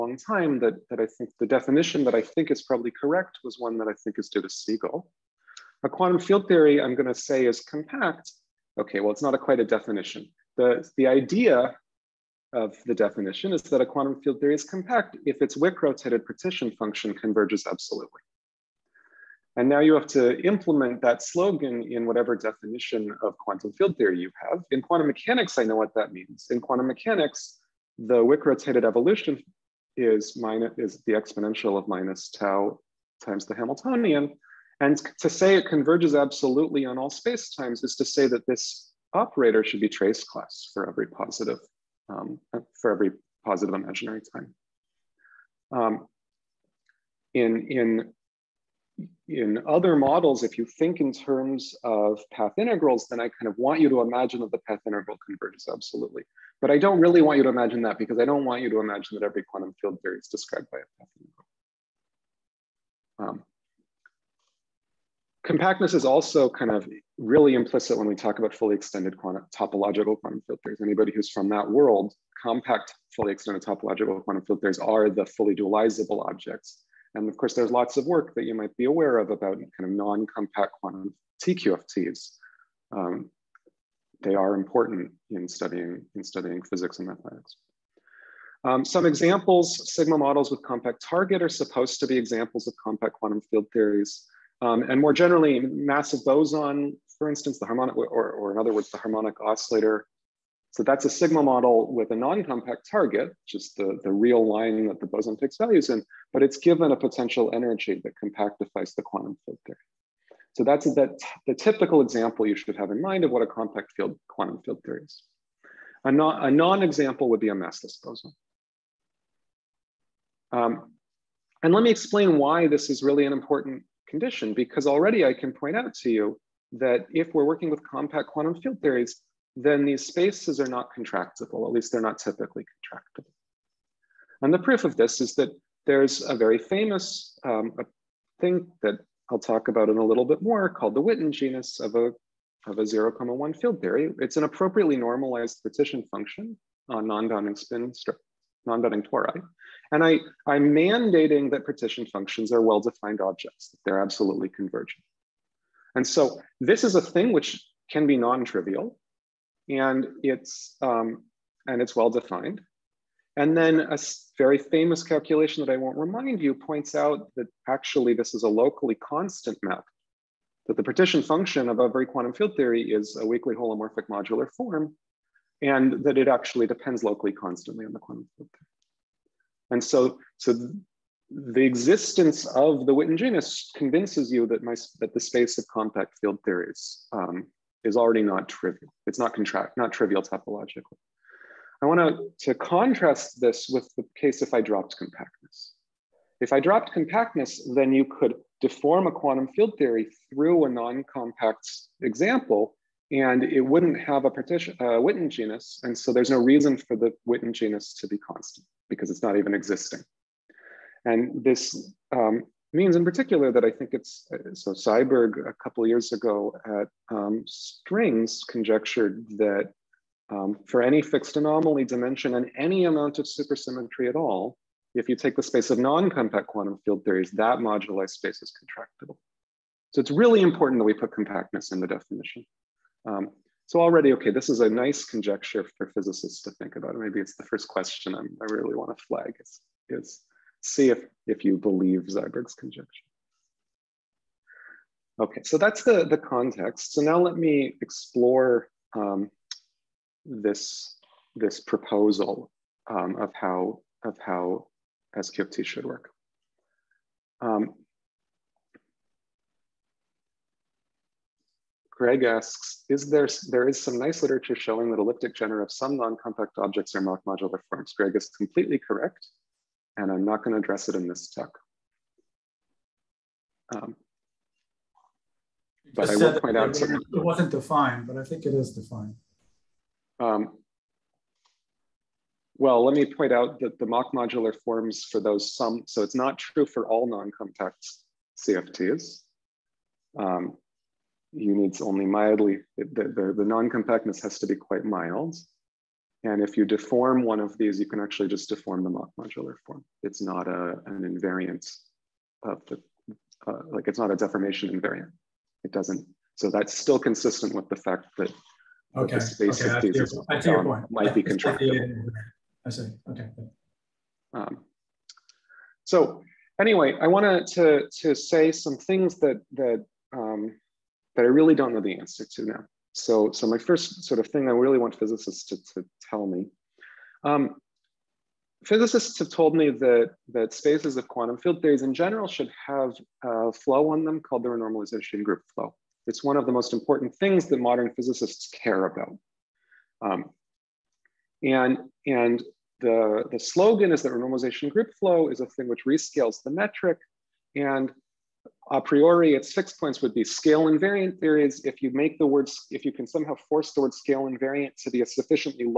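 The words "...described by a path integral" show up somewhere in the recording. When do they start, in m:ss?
1:00.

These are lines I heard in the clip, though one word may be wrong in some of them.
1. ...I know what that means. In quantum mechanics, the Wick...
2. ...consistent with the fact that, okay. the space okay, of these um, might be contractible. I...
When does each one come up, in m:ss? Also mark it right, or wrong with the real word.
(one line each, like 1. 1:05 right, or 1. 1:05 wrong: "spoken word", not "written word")
1. 0:25 right
2. 5:06 right.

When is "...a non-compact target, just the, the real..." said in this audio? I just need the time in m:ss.
1:42.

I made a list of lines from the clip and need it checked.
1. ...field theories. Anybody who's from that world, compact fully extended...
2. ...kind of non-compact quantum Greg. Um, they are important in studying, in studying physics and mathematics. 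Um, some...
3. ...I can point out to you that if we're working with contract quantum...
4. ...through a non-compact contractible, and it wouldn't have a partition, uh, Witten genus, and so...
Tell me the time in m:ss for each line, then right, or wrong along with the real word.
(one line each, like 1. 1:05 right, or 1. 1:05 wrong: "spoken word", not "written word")
1. 1:10 right
2. 1:19 wrong: "TQFTs", not "Greg"
3. 2:05 wrong: "compact", not "contract"
4. 3:20 wrong: "example", not "contractible".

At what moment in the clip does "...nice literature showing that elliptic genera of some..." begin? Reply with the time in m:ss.
4:23.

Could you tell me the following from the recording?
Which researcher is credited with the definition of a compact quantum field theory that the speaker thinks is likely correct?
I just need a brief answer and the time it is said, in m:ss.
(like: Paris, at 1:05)
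Segal, at 0:04.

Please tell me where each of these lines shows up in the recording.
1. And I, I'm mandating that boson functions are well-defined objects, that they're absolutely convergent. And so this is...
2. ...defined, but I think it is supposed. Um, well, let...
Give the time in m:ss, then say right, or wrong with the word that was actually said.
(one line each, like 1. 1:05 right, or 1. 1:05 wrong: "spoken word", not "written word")
1. 2:29 wrong: "partition", not "boson"
2. 4:37 wrong: "defined", not "supposed".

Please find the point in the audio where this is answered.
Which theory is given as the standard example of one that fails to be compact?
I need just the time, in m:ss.
1:57.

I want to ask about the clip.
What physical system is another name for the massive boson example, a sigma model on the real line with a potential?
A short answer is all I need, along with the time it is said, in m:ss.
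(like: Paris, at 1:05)
the harmonic oscillator, at 1:38.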